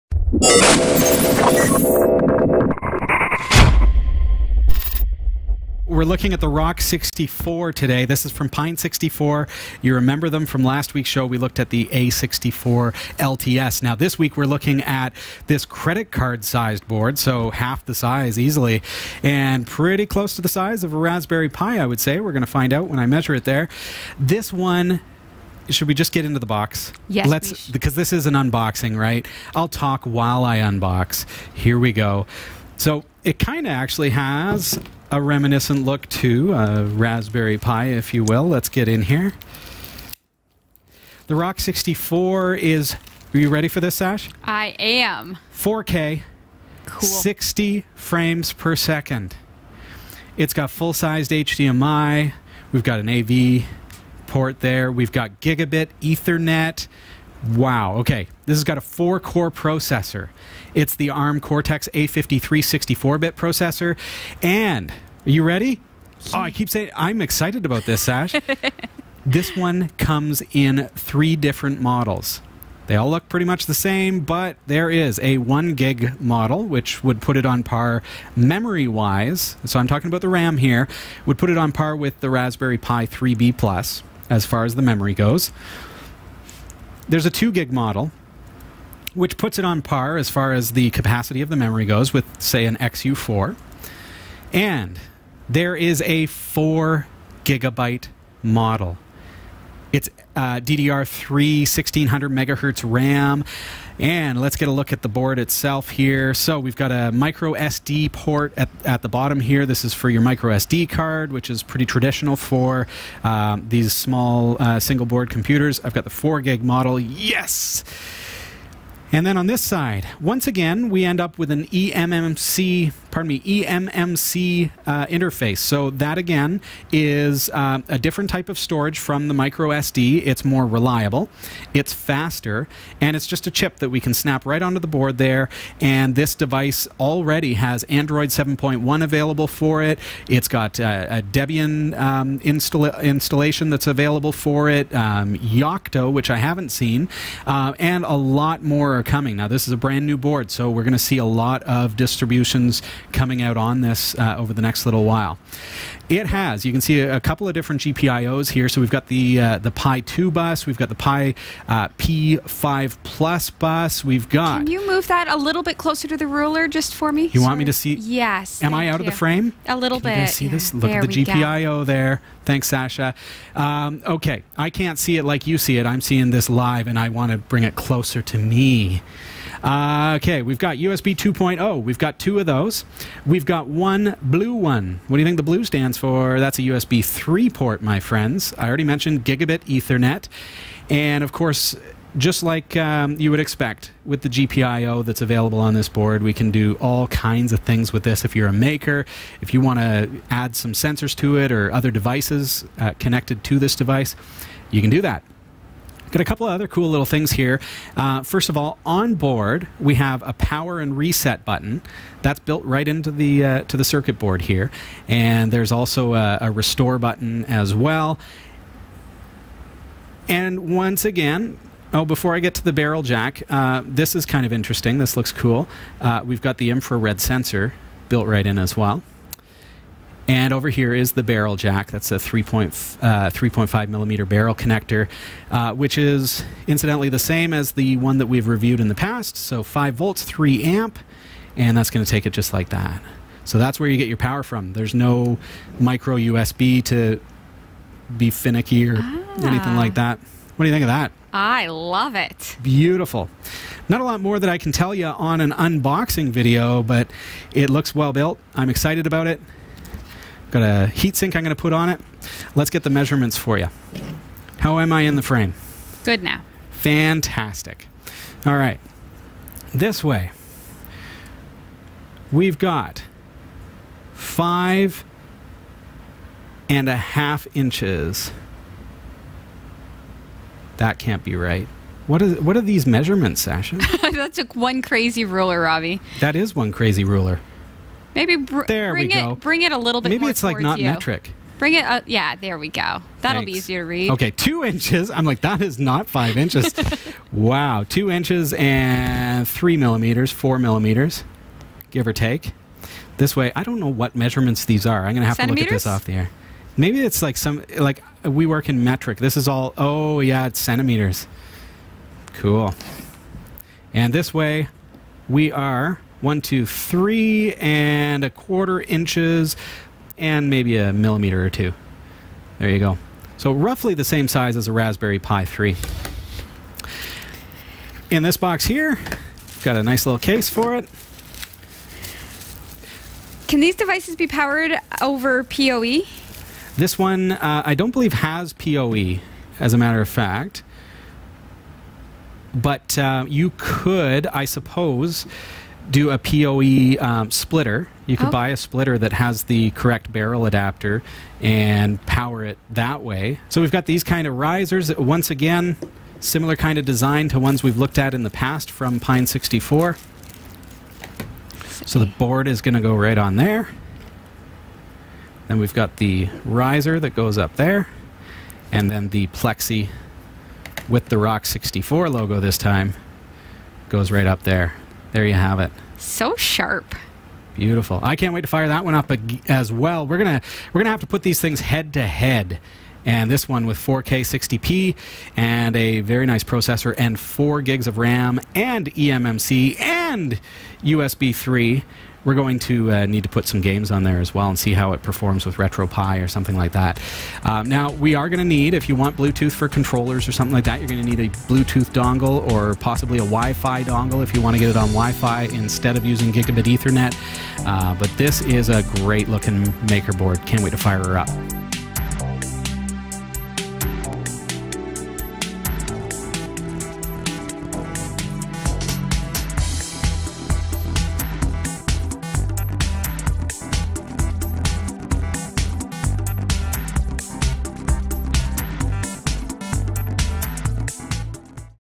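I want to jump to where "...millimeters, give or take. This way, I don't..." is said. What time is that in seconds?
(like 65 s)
300 s.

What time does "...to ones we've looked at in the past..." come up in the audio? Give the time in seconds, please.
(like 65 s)
357 s.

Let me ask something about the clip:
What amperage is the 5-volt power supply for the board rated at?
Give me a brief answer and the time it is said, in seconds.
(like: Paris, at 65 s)
3 amp, at 240 s.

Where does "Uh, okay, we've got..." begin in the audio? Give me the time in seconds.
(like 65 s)
179 s.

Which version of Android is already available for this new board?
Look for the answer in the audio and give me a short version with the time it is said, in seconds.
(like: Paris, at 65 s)
Android 7.1, at 137 s.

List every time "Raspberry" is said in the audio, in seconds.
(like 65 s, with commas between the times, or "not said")
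20 s, 36 s, 82 s, 324 s.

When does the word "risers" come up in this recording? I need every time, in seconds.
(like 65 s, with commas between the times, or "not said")
354 s, 366 s.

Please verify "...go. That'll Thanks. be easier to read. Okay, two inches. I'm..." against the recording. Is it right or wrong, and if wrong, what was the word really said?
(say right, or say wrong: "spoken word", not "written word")
right.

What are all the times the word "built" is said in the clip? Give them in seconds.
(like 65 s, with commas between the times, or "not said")
212 s, 228 s, 258 s.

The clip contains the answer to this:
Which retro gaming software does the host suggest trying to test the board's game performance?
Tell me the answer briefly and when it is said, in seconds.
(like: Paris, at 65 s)
RetroPie, at 395 s.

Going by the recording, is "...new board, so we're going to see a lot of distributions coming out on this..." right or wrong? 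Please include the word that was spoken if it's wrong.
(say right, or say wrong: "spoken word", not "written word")
right.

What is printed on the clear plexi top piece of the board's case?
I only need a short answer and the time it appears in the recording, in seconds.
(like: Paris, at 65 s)
Rock 64 logo, at 371 s.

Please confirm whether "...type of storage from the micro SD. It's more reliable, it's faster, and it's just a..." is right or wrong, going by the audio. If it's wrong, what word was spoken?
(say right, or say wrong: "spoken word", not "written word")
right.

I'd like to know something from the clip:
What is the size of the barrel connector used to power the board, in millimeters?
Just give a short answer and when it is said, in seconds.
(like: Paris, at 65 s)
3.5, at 232 s.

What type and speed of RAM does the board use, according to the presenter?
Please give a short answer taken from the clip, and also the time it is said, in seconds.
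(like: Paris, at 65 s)
DDR3 1600 megahertz, at 100 s.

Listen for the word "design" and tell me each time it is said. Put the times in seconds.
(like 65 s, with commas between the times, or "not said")
356 s.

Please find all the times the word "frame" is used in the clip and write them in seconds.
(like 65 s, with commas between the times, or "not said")
47 s, 169 s, 265 s.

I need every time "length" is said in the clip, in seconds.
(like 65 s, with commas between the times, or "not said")
not said.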